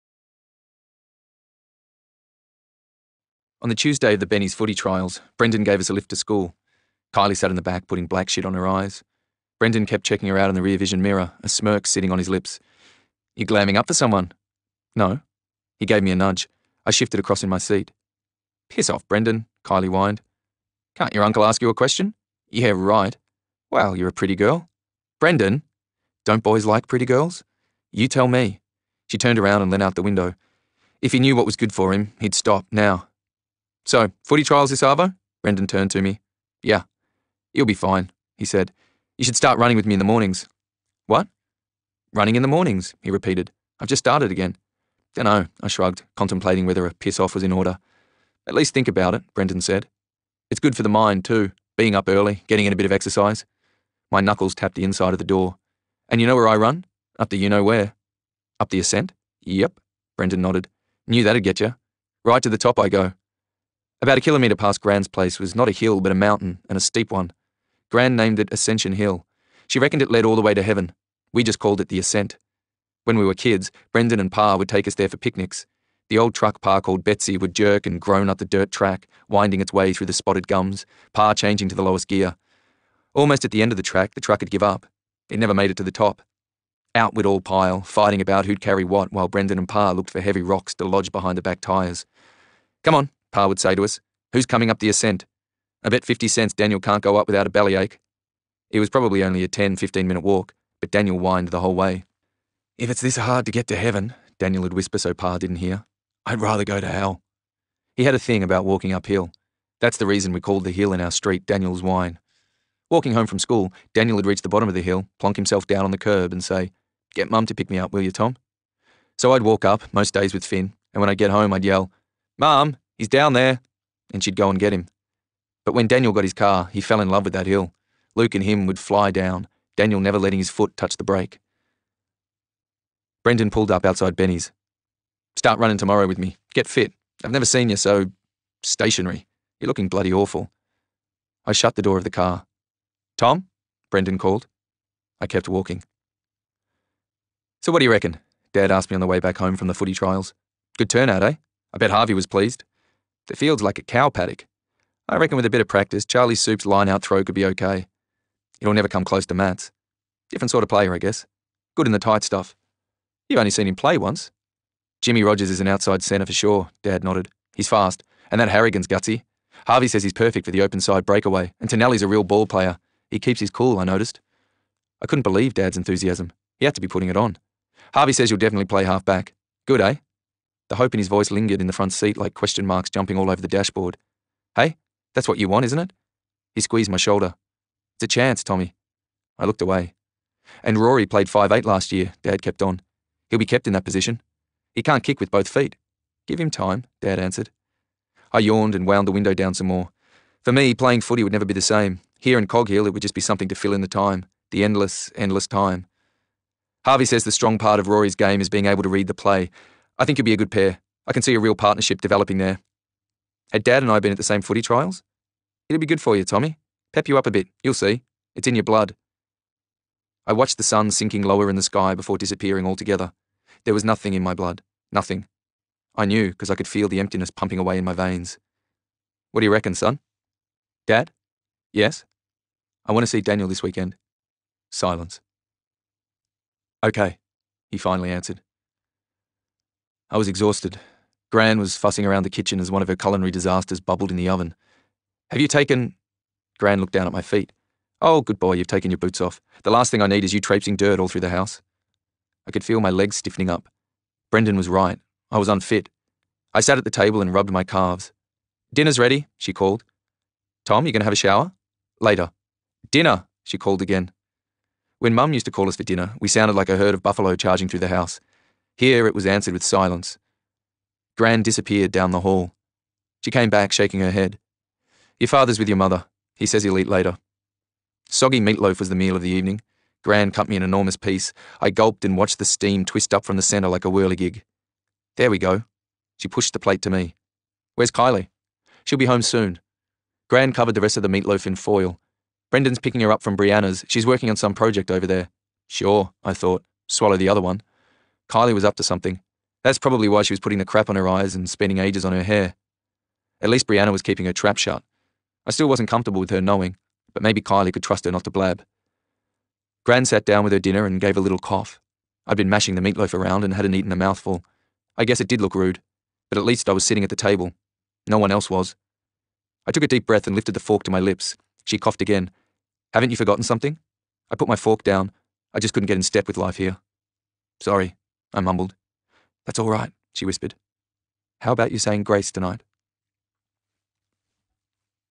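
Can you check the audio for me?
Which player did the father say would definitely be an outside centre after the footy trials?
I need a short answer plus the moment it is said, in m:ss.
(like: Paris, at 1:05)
Jimmy Rogers, at 2:45.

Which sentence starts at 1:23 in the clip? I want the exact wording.
Almost at the end of the track, the truck would give up.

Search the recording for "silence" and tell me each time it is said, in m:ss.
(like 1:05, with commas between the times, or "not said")
3:54, 4:29.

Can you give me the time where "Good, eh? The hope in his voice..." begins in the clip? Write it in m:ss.
2:59.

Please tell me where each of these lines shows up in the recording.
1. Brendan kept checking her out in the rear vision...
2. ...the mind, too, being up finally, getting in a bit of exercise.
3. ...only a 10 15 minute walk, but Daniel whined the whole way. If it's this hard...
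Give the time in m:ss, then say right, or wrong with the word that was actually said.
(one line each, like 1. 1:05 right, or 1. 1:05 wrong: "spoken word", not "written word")
1. 0:09 right
2. 0:50 wrong: "early", not "finally"
3. 1:39 right.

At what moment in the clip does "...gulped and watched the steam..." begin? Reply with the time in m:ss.
4:41.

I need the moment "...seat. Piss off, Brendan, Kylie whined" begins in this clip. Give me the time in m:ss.
0:17.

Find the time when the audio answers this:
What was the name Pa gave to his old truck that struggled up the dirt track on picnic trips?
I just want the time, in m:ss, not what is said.
1:17.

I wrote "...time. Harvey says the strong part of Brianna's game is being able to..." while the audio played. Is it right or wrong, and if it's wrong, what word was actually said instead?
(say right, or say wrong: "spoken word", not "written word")
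wrong: "Rory", not "Brianna".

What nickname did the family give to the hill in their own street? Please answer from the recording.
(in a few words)
Daniel's Whine.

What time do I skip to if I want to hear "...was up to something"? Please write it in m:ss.
4:58.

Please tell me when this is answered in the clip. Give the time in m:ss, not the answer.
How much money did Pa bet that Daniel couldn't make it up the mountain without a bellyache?
1:36.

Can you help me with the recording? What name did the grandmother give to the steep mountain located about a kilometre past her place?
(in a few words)
Ascension Hill.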